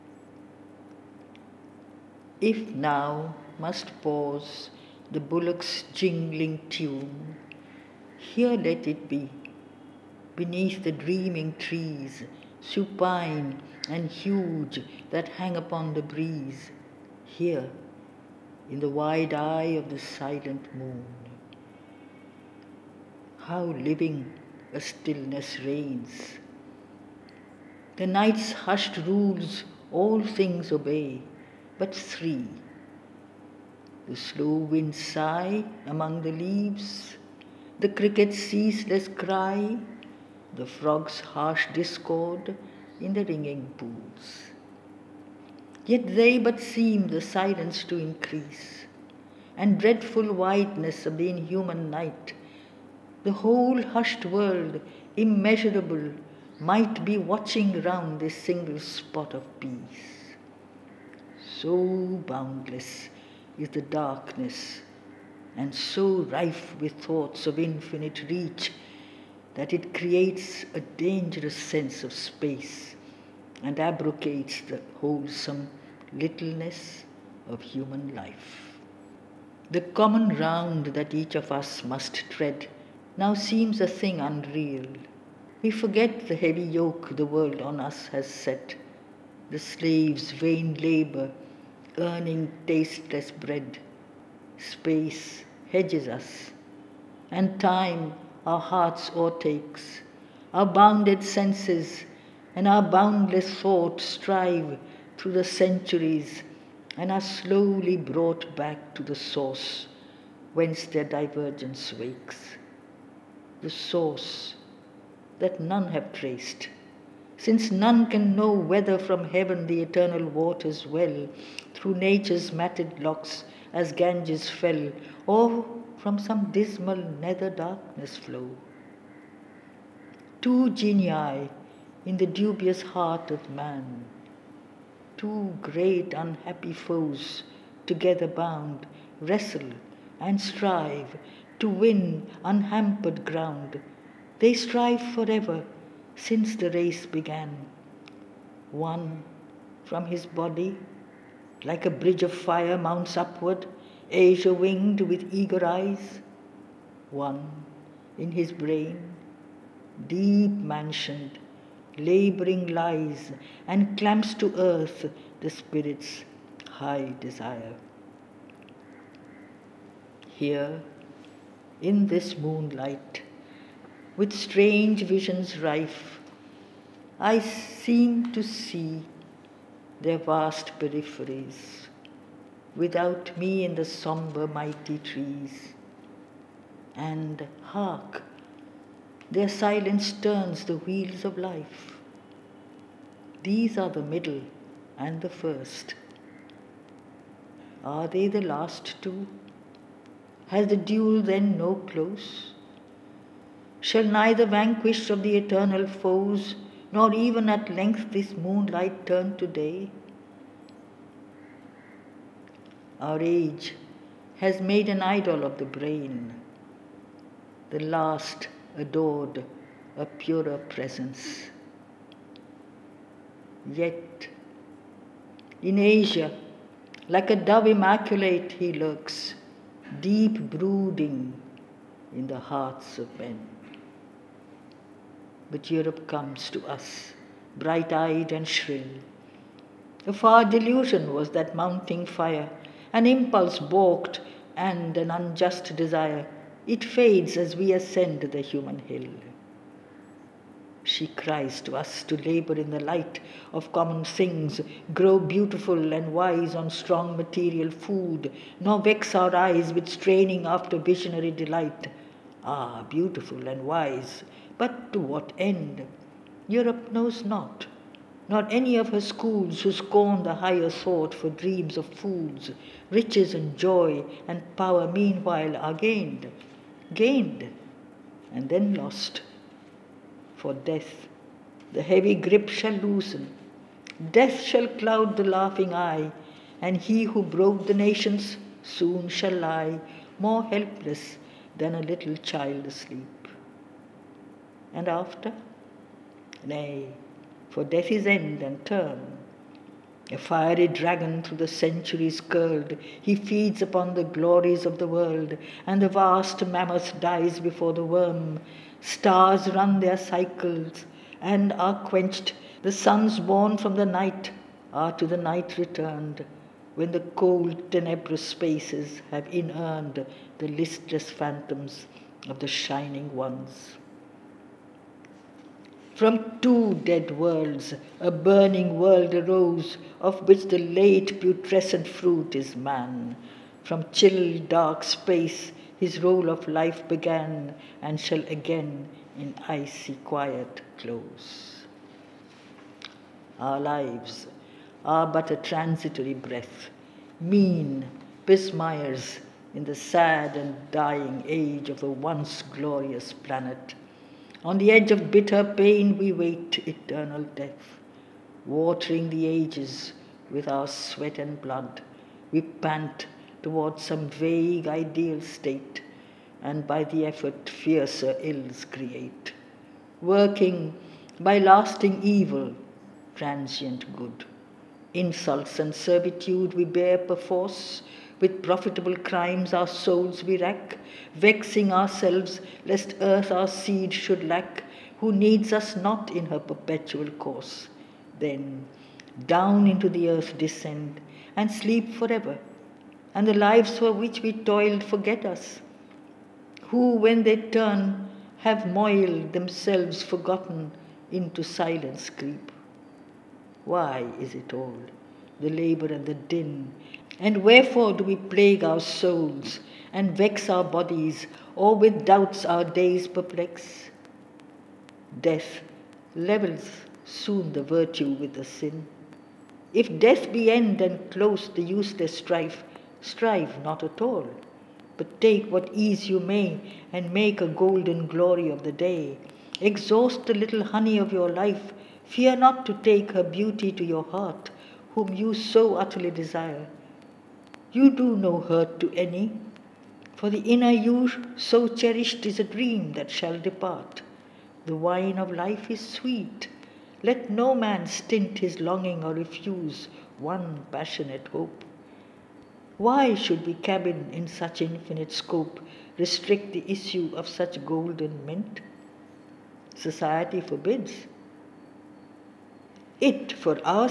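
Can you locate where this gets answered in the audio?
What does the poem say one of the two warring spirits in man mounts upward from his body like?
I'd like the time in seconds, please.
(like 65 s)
151 s.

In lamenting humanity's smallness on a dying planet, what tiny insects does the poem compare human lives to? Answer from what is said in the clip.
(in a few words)
Pismires.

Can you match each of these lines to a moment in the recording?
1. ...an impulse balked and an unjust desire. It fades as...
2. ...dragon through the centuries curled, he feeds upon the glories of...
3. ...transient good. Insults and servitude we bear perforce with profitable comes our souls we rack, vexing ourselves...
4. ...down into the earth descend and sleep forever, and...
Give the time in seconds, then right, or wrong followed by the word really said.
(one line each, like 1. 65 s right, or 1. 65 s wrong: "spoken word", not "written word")
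1. 242 s right
2. 300 s right
3. 373 s wrong: "crimes", not "comes"
4. 389 s right.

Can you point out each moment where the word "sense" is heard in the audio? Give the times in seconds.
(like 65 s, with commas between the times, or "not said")
71 s, 101 s.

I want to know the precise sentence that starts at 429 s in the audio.
Exhaust the little honey of your life, fear not to take her beauty to your heart, whom you so utterly desire.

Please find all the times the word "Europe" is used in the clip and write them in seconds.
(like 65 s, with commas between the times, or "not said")
235 s, 266 s.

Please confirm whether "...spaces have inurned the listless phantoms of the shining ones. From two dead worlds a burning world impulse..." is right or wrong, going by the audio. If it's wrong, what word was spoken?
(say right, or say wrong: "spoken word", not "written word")
wrong: "arose", not "impulse".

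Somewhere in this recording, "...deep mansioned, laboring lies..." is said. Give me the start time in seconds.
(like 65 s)
160 s.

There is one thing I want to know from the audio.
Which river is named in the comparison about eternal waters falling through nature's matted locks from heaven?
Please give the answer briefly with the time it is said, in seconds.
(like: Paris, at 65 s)
Ganges, at 123 s.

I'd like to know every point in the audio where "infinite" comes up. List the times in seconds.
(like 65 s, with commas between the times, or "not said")
67 s, 454 s.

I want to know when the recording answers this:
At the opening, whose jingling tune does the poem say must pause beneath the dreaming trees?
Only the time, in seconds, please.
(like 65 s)
5 s.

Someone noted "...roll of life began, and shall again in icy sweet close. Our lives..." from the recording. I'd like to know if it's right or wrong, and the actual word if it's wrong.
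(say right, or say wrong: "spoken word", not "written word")
wrong: "quiet", not "sweet".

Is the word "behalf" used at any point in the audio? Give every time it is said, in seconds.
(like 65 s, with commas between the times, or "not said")
not said.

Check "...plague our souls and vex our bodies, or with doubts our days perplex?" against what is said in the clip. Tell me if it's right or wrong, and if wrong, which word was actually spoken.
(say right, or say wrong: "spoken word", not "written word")
right.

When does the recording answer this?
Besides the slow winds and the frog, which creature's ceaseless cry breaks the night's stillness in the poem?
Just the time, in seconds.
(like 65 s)
37 s.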